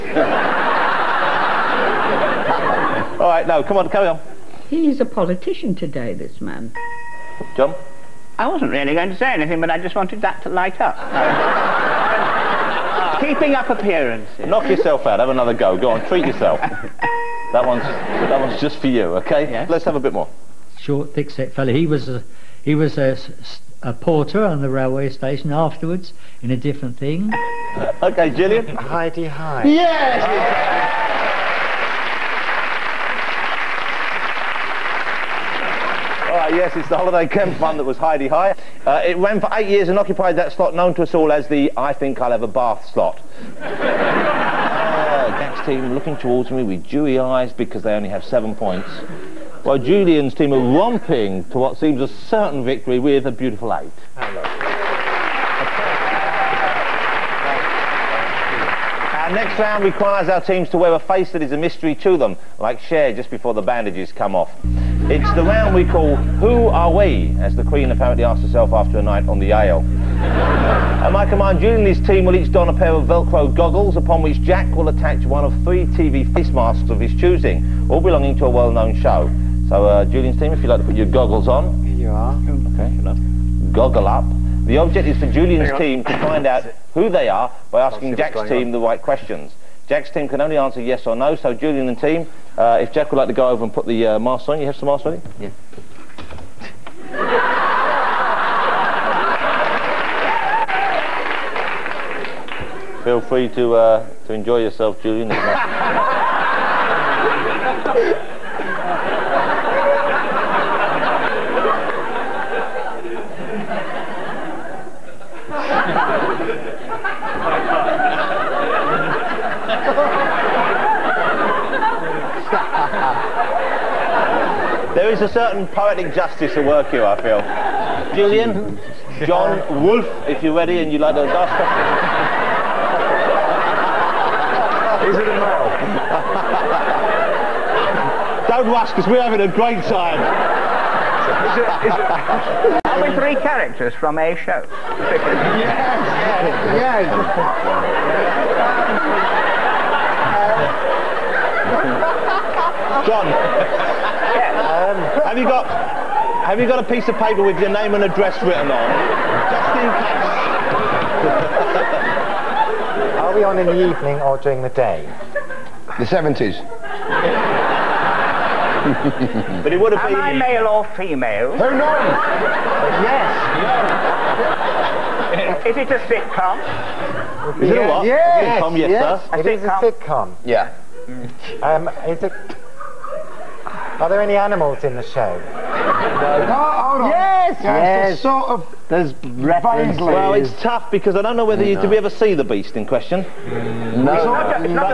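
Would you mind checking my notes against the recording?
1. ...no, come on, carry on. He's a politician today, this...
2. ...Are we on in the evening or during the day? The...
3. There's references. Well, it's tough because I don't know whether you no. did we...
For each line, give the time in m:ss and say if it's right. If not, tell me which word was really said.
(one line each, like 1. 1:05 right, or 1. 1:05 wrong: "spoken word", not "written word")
1. 0:03 right
2. 2:43 right
3. 3:08 right.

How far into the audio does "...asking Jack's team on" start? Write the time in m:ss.
1:27.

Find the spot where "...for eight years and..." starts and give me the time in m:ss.
0:39.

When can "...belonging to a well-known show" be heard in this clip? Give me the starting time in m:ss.
1:18.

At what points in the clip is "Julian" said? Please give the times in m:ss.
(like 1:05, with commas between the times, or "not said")
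0:49, 1:11, 1:20, 1:25, 1:31, 1:45, 2:08.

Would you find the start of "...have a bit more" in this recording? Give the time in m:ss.
0:19.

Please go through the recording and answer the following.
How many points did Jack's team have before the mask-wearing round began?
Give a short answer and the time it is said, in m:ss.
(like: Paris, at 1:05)
7, at 0:48.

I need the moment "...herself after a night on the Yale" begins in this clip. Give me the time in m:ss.
1:08.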